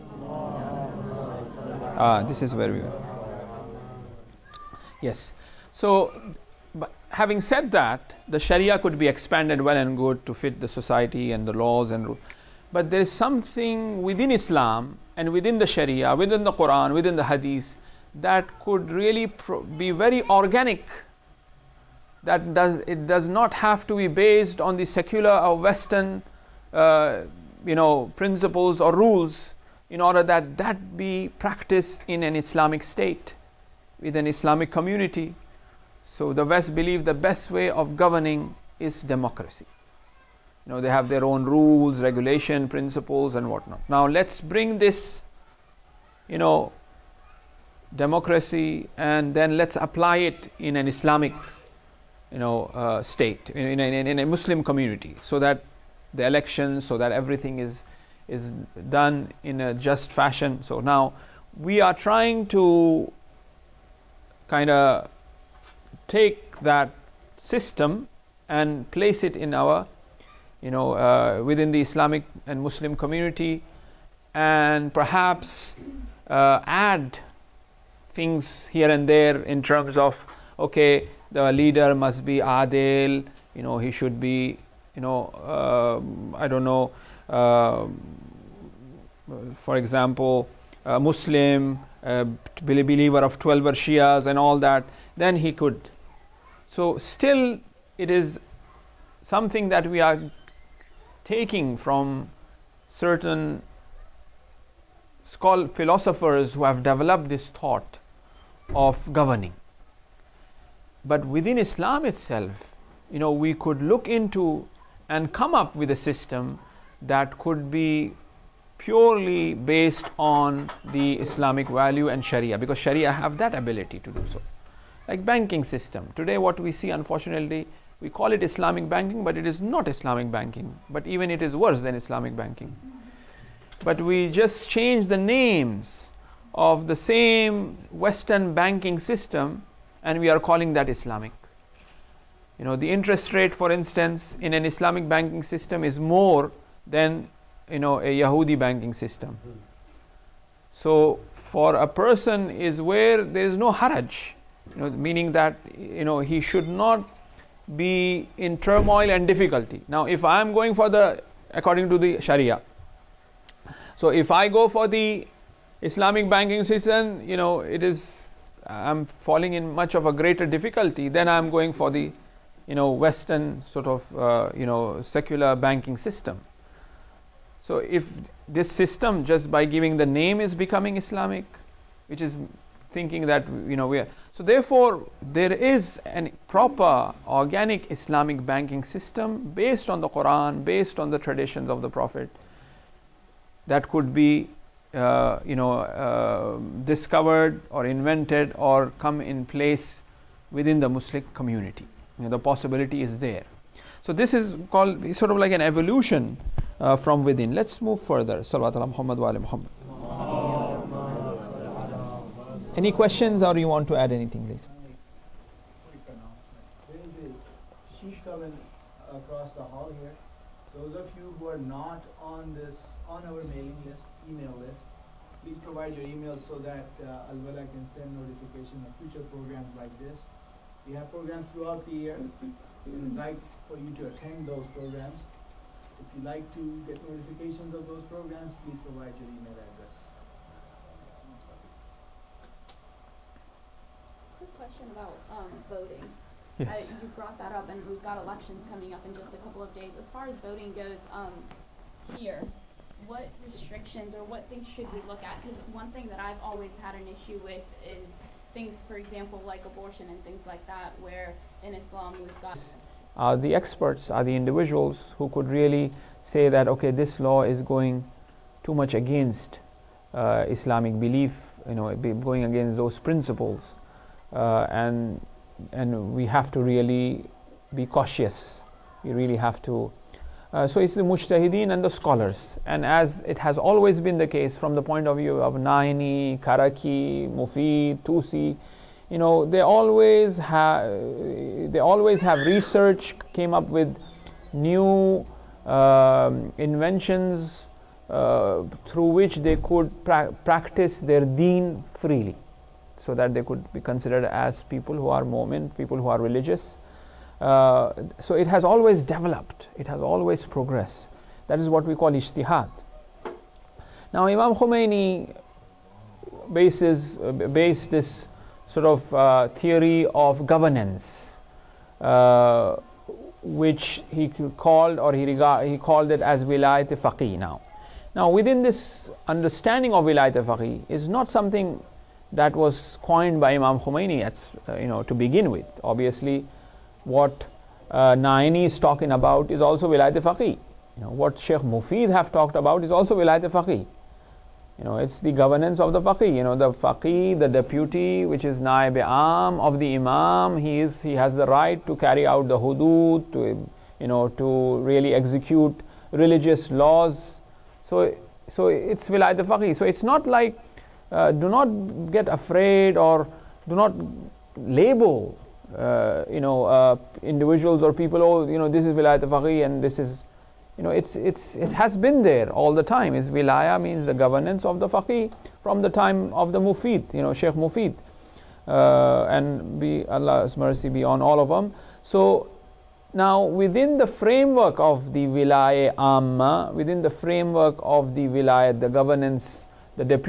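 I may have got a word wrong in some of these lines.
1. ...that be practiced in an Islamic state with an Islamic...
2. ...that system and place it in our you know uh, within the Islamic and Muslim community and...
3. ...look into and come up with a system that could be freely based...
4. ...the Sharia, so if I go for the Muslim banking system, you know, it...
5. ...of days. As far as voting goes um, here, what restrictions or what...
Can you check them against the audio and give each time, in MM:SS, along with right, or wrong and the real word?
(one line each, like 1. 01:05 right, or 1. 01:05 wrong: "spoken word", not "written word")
1. 00:30 right
2. 01:06 right
3. 01:53 wrong: "purely", not "freely"
4. 02:41 wrong: "Islamic", not "Muslim"
5. 04:09 right.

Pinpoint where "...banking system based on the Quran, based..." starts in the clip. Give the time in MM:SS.
03:08.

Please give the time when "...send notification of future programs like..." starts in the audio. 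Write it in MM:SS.
03:47.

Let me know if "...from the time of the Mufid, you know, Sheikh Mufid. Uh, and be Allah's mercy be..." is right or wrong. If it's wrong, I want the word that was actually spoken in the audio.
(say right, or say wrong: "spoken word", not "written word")
right.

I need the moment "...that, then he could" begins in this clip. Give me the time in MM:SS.
01:34.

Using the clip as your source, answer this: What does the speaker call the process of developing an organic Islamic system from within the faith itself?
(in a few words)
evolution.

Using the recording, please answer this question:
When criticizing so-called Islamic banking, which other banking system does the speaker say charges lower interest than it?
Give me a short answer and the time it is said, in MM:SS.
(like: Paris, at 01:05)
Yahudi banking system, at 02:28.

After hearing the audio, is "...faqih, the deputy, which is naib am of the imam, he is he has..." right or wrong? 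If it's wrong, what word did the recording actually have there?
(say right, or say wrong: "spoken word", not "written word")
right.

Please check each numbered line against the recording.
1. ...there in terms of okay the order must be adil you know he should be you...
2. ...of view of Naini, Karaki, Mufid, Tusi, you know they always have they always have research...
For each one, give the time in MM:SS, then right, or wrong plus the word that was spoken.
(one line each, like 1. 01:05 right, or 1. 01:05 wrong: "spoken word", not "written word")
1. 01:19 wrong: "leader", not "order"
2. 04:45 right.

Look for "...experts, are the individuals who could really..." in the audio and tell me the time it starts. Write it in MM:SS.
04:23.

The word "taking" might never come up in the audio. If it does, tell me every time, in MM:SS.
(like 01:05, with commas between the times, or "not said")
01:41.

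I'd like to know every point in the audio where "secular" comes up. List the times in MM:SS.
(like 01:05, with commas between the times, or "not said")
00:24, 02:55.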